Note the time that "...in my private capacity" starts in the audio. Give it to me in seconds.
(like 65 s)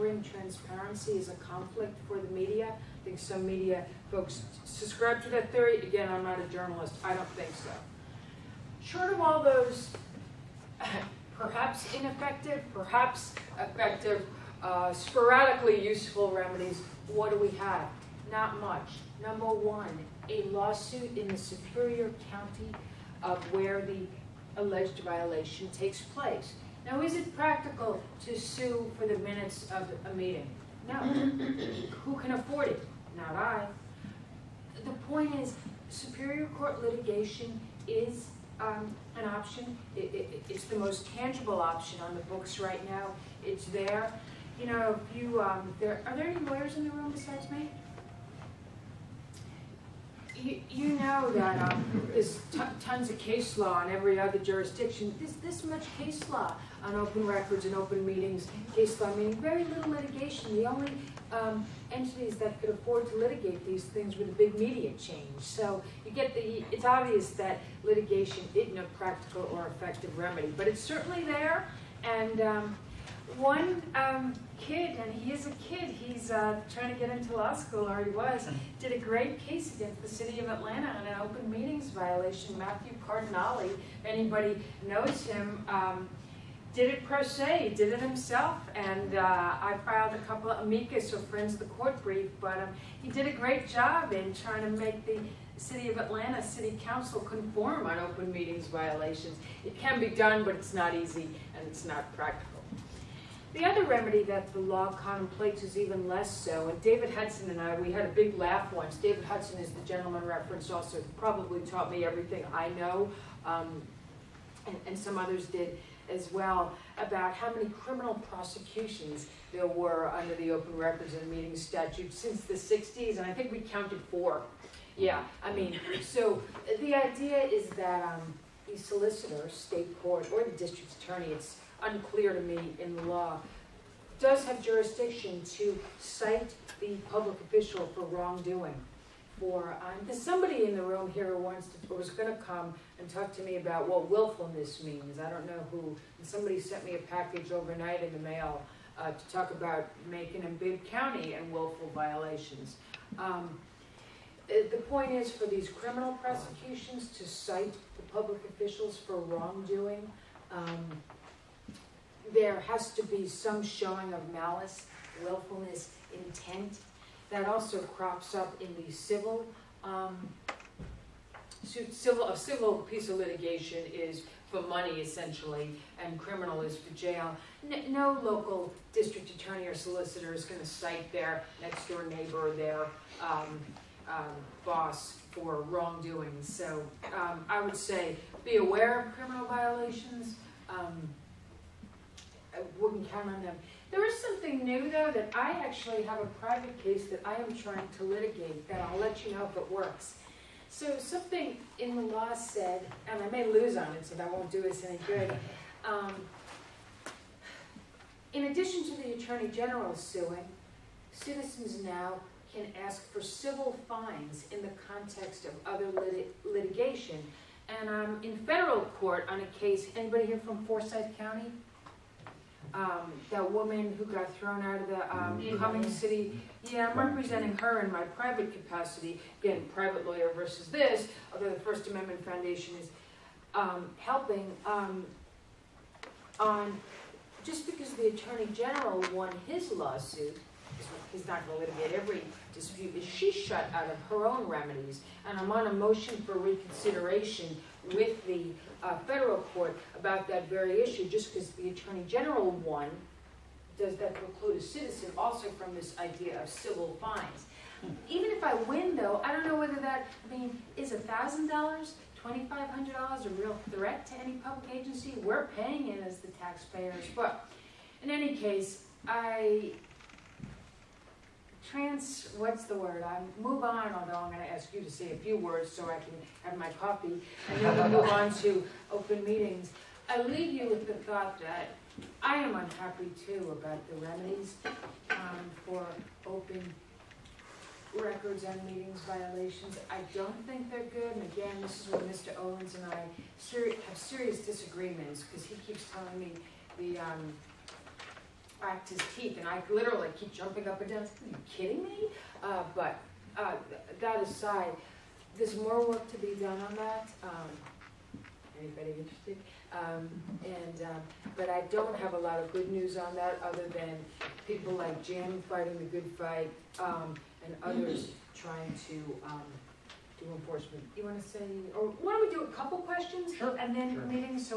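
227 s.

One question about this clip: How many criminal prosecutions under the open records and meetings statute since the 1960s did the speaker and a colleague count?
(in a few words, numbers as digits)
4.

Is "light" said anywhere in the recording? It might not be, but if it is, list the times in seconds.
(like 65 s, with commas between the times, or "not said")
not said.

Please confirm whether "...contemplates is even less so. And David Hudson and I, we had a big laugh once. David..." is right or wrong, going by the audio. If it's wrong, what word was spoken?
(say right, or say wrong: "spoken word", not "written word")
right.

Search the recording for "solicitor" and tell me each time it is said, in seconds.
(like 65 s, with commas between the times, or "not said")
128 s, 179 s.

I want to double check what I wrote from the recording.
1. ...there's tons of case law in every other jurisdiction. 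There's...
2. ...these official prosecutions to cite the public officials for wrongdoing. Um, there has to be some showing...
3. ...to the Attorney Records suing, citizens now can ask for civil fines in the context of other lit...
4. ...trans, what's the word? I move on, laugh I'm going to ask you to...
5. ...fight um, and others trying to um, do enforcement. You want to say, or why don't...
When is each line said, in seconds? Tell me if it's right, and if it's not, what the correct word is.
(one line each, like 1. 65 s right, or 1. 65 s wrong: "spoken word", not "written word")
1. 52 s right
2. 155 s wrong: "criminal", not "official"
3. 208 s wrong: "General", not "Records"
4. 271 s wrong: "although", not "laugh"
5. 316 s right.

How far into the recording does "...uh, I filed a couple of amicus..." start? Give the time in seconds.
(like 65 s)
89 s.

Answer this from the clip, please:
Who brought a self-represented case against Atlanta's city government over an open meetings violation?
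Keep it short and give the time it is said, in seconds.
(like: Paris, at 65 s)
Matthew Cardinale, at 82 s.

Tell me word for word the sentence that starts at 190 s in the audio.
Um, I wouldn't count on them.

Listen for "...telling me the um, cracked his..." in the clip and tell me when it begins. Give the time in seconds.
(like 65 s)
295 s.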